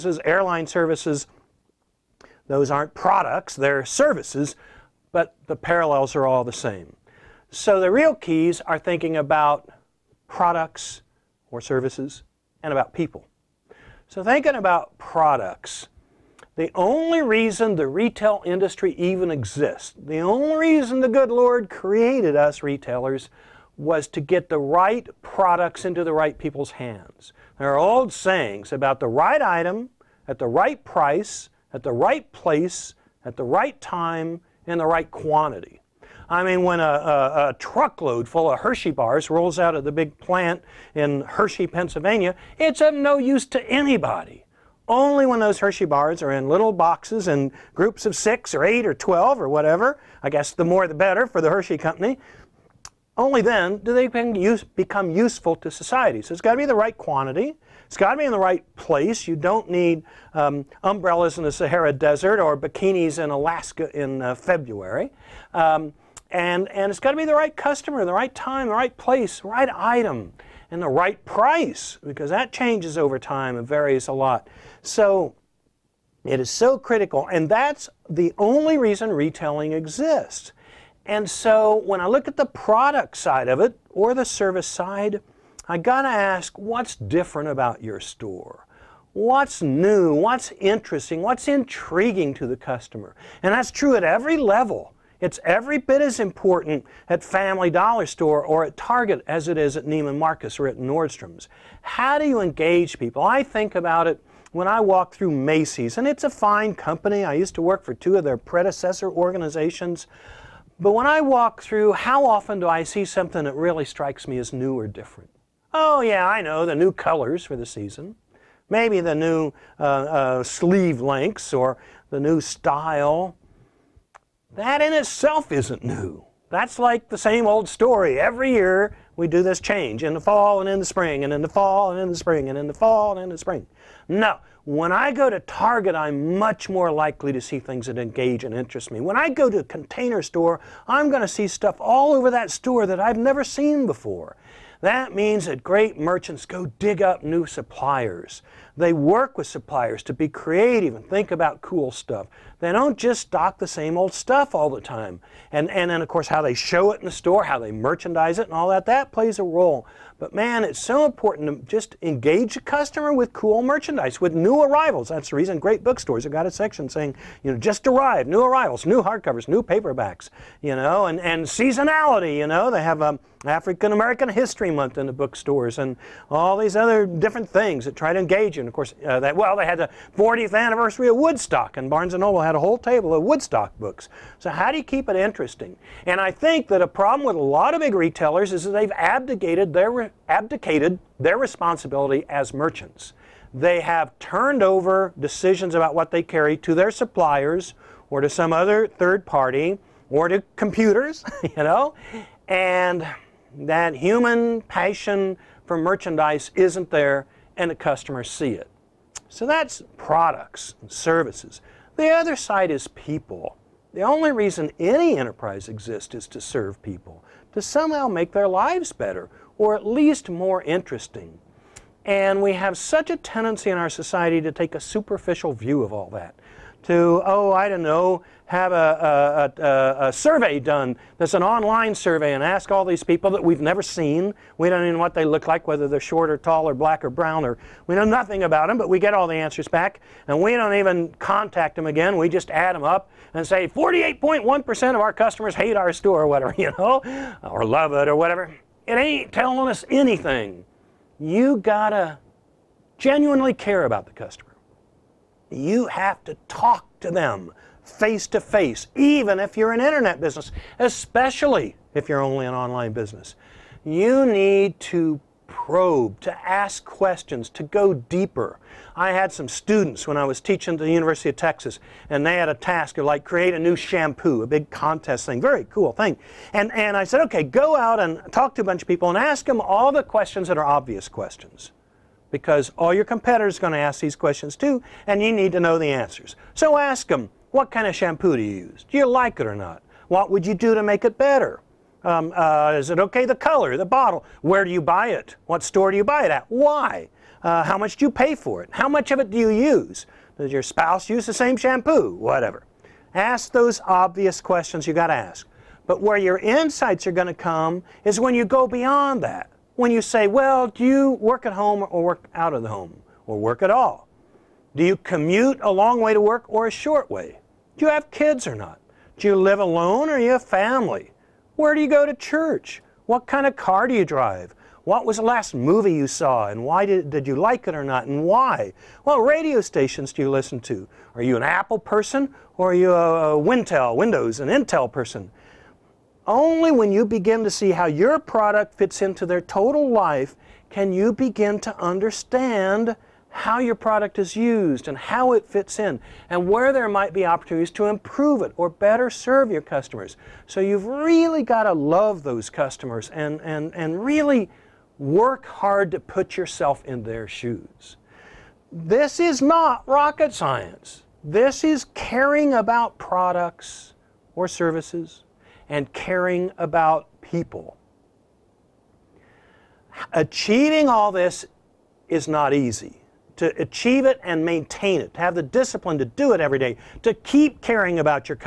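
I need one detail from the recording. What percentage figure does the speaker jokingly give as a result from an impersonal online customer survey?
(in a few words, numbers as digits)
48.1%.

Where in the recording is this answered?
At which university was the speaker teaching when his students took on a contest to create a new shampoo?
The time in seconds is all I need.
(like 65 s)
270 s.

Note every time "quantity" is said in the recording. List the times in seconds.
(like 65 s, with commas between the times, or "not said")
35 s, 56 s.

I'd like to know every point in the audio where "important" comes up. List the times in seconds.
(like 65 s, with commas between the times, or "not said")
96 s, 161 s.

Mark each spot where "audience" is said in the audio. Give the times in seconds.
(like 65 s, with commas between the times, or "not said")
not said.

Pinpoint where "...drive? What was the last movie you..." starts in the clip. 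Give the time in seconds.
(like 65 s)
324 s.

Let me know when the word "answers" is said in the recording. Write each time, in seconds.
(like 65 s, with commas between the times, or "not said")
239 s, 285 s.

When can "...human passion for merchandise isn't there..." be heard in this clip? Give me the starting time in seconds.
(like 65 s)
203 s.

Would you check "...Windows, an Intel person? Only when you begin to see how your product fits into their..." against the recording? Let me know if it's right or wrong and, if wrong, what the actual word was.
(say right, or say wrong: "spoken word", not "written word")
right.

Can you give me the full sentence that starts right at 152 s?
They don't just stock the same old stuff all the time.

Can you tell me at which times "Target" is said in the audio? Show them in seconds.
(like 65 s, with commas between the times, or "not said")
98 s, 135 s.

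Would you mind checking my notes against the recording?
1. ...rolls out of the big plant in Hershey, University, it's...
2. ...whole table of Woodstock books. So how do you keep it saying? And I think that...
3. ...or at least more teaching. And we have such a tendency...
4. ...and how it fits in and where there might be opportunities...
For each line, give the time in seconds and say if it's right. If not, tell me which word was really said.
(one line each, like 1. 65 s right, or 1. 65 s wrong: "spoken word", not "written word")
1. 39 s wrong: "Pennsylvania", not "University"
2. 182 s wrong: "interesting", not "saying"
3. 219 s wrong: "interesting", not "teaching"
4. 344 s right.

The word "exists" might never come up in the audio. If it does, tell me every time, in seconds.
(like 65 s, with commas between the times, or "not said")
19 s, 79 s, 215 s.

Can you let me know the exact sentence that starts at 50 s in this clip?
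I guess the more the better for the Hershey company.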